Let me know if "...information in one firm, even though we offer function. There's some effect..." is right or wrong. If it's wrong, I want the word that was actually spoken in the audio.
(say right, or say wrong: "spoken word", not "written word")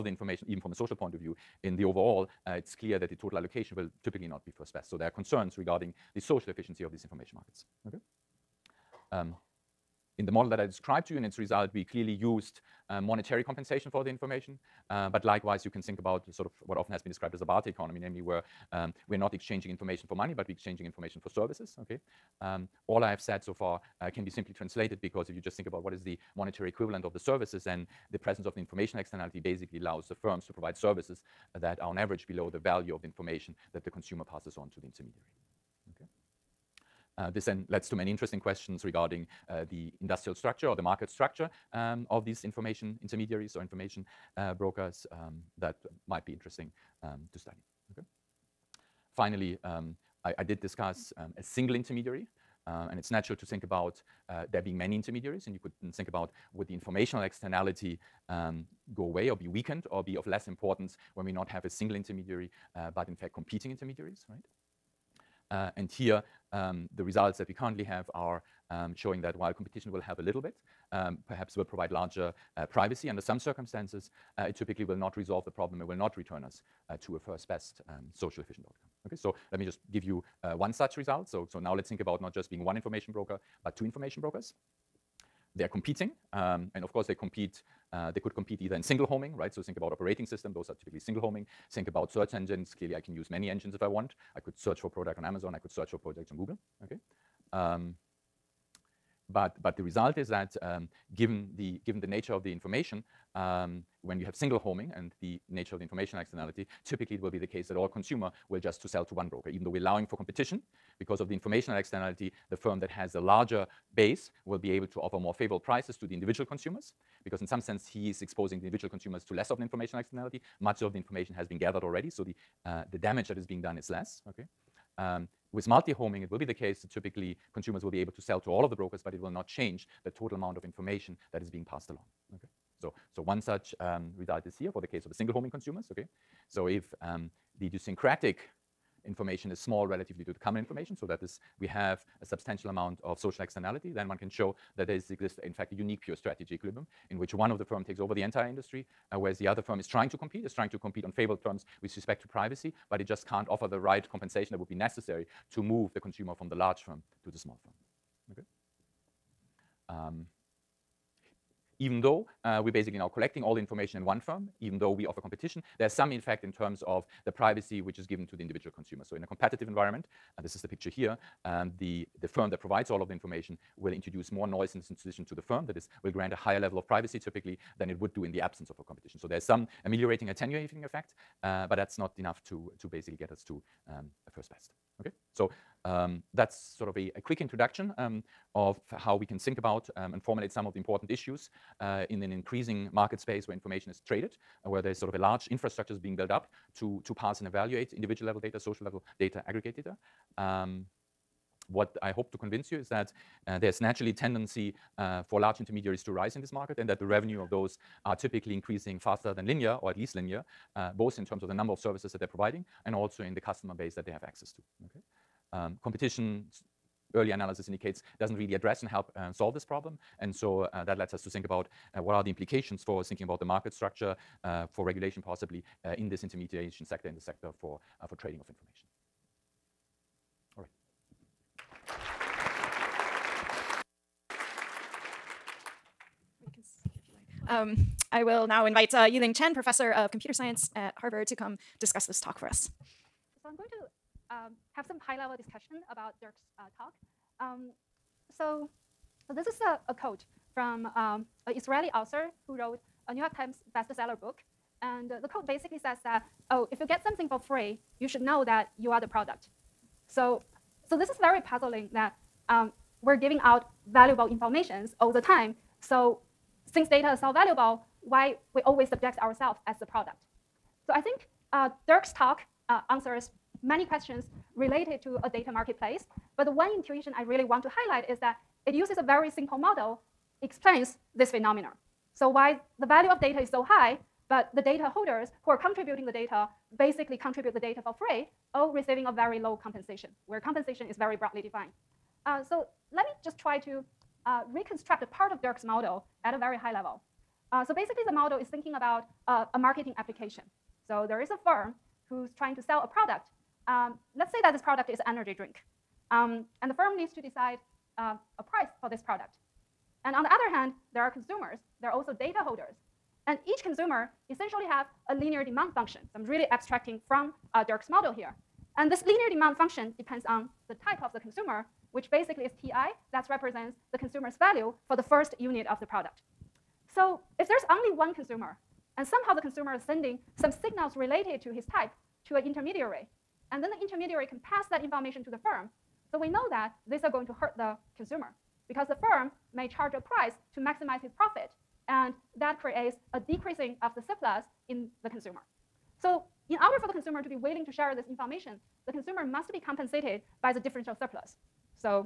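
wrong: "competition", not "function".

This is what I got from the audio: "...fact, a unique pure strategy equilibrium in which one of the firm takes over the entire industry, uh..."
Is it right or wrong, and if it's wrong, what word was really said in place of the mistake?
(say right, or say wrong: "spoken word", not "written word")
right.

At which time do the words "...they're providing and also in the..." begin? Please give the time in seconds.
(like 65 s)
212 s.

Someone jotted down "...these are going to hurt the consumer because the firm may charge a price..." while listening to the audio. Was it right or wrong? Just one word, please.
right.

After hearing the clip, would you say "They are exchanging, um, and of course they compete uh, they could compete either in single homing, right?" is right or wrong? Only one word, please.
wrong.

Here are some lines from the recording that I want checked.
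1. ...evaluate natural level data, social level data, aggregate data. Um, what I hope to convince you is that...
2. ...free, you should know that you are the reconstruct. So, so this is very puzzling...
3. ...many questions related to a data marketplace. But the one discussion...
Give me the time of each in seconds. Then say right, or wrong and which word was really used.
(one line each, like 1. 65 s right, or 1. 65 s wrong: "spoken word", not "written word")
1. 197 s wrong: "individual", not "natural"
2. 257 s wrong: "product", not "reconstruct"
3. 273 s wrong: "intuition", not "discussion".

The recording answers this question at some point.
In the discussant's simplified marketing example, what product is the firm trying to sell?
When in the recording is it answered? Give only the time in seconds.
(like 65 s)
305 s.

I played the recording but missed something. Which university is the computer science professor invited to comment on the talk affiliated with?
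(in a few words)
Harvard.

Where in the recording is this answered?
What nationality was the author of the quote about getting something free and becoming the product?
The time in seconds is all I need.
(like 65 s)
251 s.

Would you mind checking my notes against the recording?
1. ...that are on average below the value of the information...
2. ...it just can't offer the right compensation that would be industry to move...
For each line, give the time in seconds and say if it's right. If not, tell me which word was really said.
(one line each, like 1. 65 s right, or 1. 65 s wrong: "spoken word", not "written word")
1. 31 s right
2. 153 s wrong: "necessary", not "industry".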